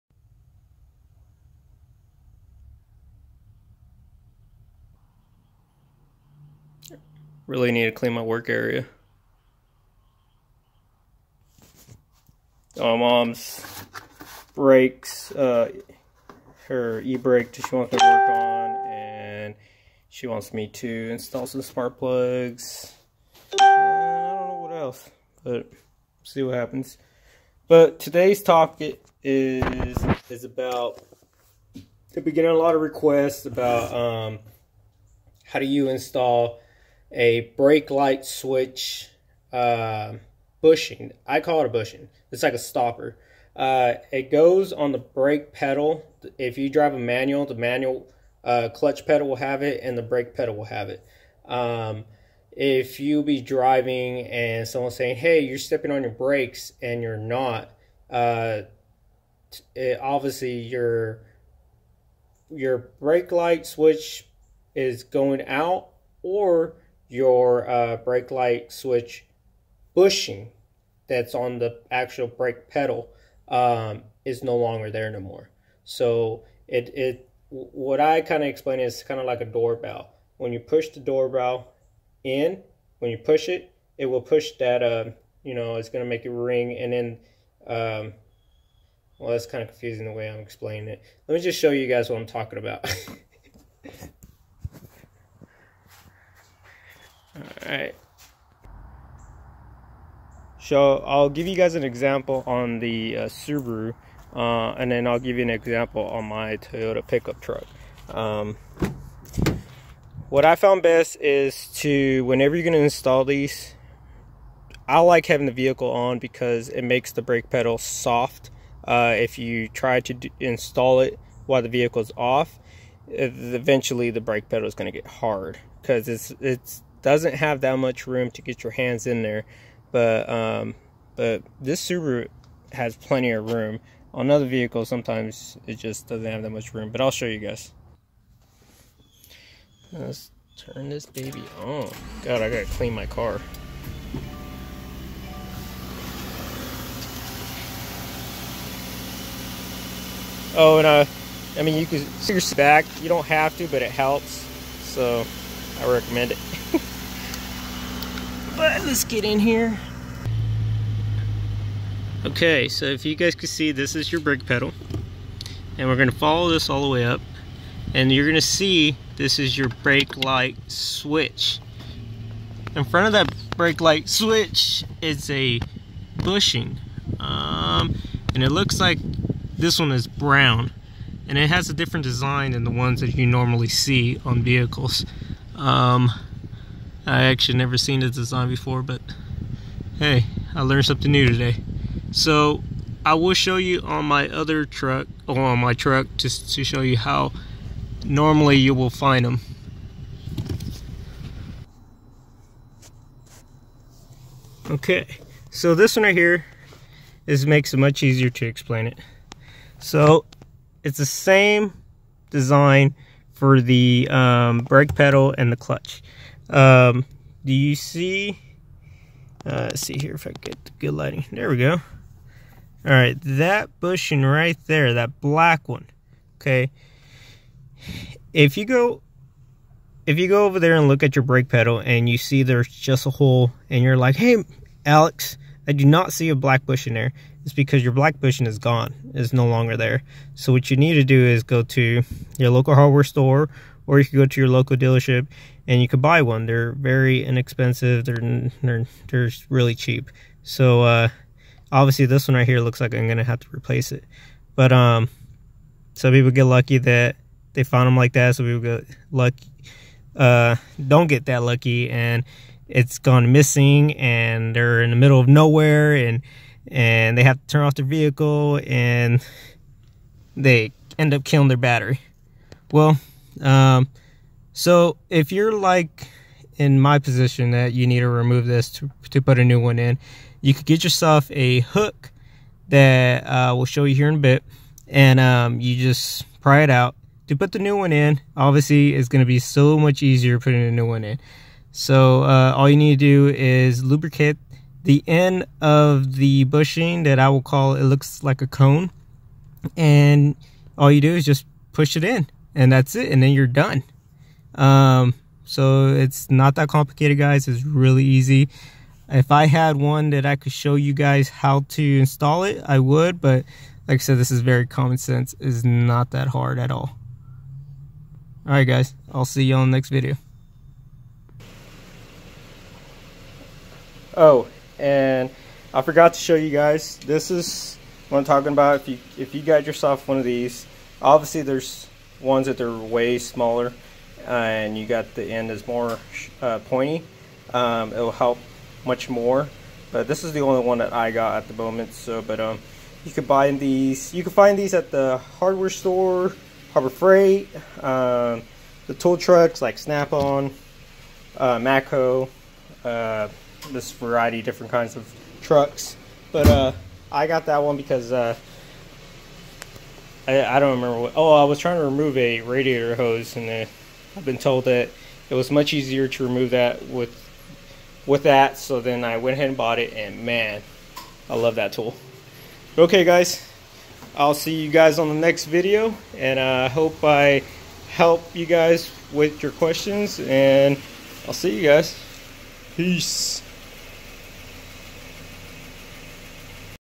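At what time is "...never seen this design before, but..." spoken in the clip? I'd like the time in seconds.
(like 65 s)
187 s.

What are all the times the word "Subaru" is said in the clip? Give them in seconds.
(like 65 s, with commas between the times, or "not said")
103 s, 131 s.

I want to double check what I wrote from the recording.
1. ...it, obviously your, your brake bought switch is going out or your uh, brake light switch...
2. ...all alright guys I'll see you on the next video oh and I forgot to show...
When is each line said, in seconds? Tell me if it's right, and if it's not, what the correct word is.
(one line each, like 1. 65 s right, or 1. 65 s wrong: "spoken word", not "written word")
1. 59 s wrong: "light", not "bought"
2. 316 s right.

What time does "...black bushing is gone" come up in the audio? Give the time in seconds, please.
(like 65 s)
237 s.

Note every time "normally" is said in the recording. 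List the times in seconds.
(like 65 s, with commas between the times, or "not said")
183 s, 198 s.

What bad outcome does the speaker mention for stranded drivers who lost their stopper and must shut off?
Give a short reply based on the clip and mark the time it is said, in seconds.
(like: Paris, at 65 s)
Killing their battery, at 271 s.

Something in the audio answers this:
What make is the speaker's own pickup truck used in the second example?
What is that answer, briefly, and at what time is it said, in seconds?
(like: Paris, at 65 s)
Toyota, at 106 s.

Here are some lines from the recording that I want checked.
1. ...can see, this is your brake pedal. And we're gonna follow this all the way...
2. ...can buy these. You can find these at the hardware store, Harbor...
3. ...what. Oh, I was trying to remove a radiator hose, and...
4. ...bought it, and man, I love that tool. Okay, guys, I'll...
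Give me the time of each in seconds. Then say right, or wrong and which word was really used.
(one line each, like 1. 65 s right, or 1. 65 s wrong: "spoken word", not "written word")
1. 163 s right
2. 343 s right
3. 360 s right
4. 369 s right.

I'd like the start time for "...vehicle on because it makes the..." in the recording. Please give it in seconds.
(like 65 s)
115 s.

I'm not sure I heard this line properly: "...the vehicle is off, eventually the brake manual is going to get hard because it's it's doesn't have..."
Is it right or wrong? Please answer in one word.
wrong.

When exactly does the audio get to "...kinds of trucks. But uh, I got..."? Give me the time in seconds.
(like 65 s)
354 s.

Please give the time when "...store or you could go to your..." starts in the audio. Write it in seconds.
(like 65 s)
243 s.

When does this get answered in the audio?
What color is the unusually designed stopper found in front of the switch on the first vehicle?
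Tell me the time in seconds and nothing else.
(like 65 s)
180 s.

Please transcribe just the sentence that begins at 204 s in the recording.
Okay, so this one right here is makes it much easier to explain it.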